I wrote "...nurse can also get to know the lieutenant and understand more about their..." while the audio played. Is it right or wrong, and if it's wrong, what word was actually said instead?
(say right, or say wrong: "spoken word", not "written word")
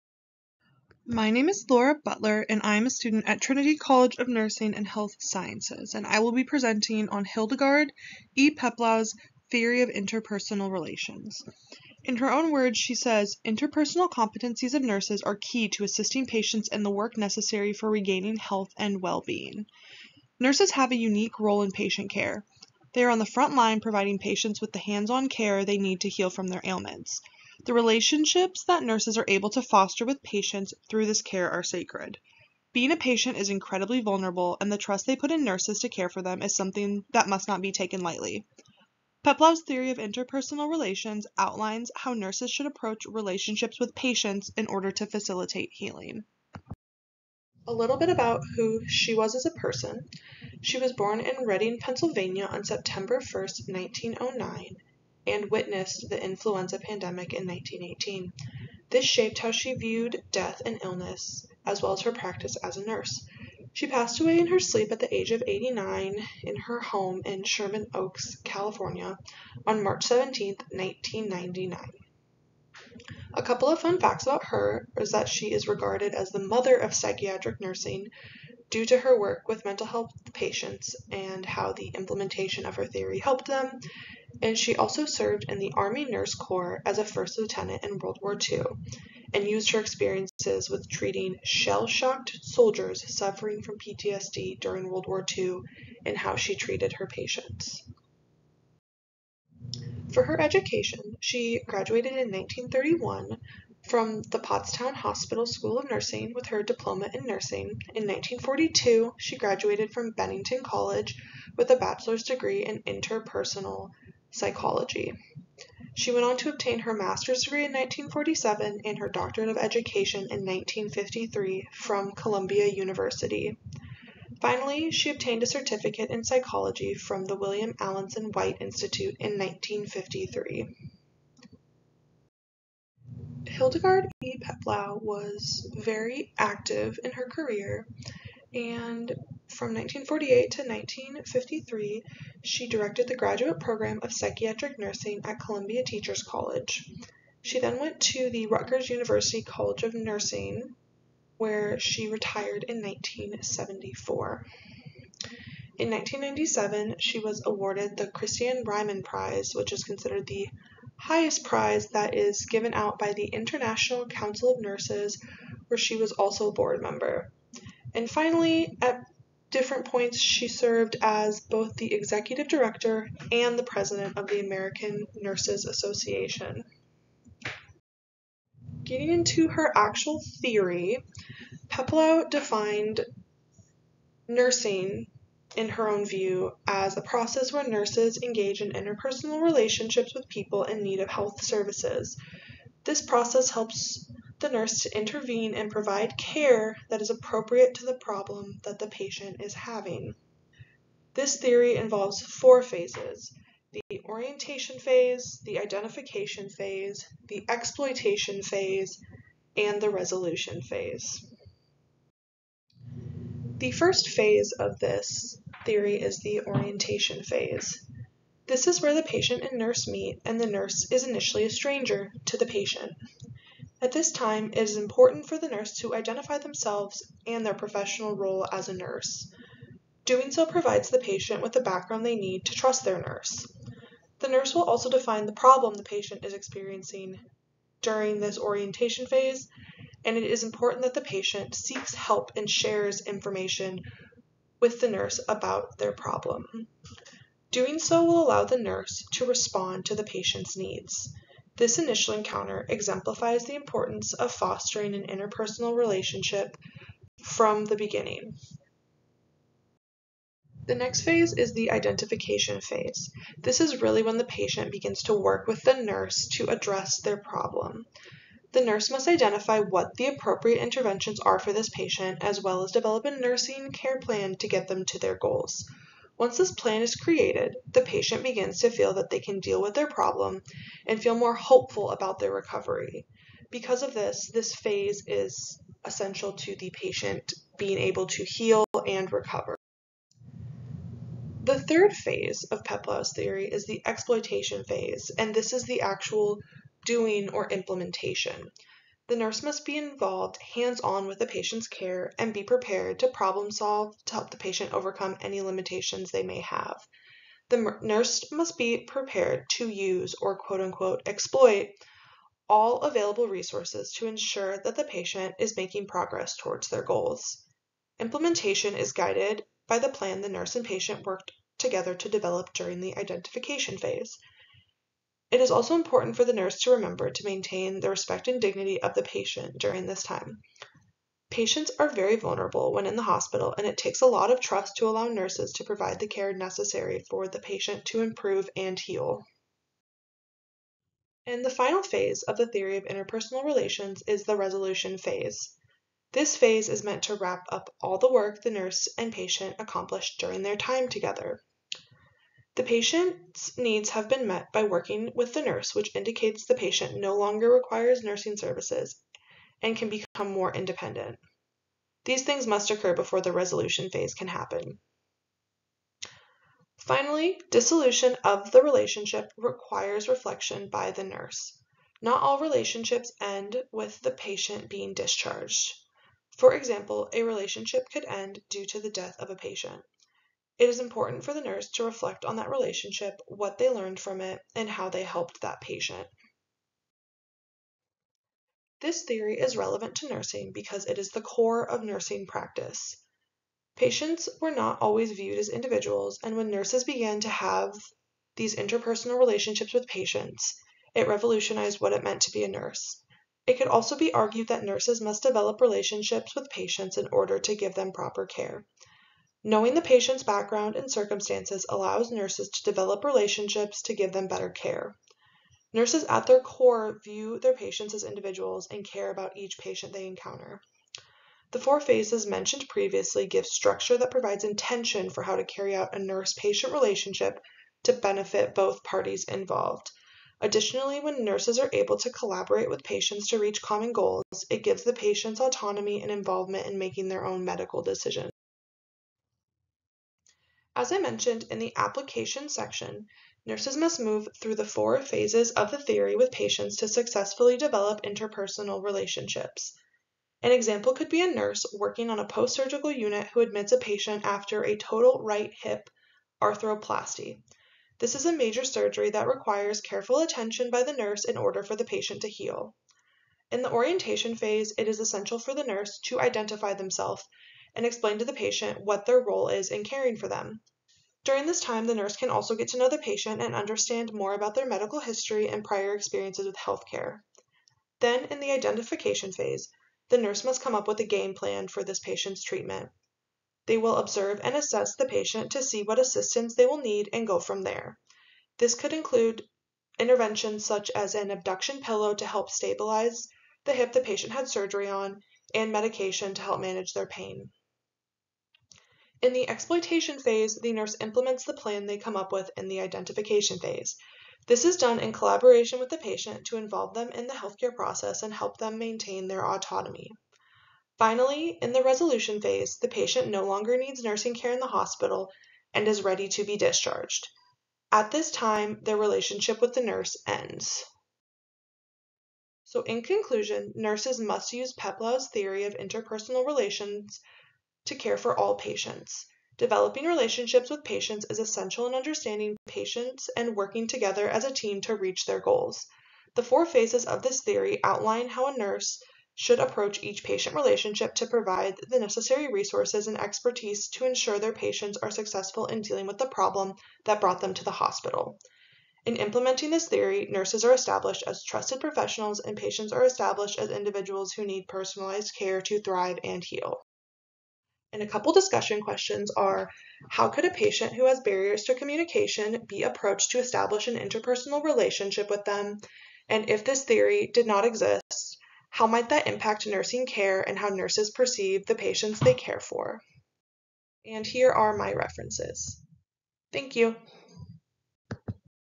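wrong: "patient", not "lieutenant".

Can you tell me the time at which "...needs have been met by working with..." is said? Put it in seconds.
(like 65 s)
353 s.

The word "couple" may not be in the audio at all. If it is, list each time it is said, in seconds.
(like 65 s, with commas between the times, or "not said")
73 s, 558 s.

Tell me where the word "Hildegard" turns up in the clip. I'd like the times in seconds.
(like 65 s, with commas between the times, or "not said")
7 s, 133 s.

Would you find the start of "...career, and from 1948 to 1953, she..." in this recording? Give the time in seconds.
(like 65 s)
137 s.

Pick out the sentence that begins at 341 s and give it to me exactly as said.
And the final phase of the theory of interpersonal relations is the resolution phase.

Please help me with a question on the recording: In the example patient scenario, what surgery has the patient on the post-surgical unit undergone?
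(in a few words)
Total right hip arthroplasty.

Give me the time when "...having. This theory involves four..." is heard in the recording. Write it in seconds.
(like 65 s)
199 s.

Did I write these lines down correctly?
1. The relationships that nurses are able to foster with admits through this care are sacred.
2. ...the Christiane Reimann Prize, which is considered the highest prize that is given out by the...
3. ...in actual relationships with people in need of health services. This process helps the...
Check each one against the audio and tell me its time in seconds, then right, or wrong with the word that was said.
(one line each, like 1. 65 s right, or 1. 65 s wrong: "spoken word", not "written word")
1. 27 s wrong: "patients", not "admits"
2. 157 s right
3. 188 s wrong: "interpersonal", not "actual".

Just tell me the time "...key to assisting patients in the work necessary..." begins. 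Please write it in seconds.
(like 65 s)
15 s.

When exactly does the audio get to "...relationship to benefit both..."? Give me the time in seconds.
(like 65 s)
426 s.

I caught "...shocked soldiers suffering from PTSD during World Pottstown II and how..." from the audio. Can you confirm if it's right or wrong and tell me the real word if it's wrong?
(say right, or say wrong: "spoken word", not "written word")
wrong: "War", not "Pottstown".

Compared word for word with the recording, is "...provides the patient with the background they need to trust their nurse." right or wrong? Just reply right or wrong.
right.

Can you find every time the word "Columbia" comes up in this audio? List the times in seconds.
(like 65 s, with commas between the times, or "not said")
122 s, 145 s.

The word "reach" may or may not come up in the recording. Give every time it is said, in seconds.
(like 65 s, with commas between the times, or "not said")
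433 s, 534 s.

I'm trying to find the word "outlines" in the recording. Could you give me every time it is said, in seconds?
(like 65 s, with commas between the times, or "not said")
41 s, 537 s.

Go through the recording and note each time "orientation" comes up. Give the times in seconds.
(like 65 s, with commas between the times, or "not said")
204 s, 216 s, 238 s, 463 s.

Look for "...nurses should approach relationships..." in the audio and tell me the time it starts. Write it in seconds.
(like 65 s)
42 s.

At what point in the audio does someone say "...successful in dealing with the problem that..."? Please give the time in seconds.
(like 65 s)
545 s.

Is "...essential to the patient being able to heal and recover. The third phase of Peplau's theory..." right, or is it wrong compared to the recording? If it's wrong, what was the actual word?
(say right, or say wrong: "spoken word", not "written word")
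right.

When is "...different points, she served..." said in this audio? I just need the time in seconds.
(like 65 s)
169 s.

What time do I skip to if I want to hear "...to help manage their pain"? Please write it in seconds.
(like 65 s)
496 s.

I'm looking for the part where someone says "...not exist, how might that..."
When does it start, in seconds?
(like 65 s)
567 s.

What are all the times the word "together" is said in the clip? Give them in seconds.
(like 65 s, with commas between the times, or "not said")
321 s, 350 s, 533 s.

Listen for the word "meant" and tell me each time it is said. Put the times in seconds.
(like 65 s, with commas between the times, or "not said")
346 s, 402 s.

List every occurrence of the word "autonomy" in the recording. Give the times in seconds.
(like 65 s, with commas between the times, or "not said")
435 s, 509 s.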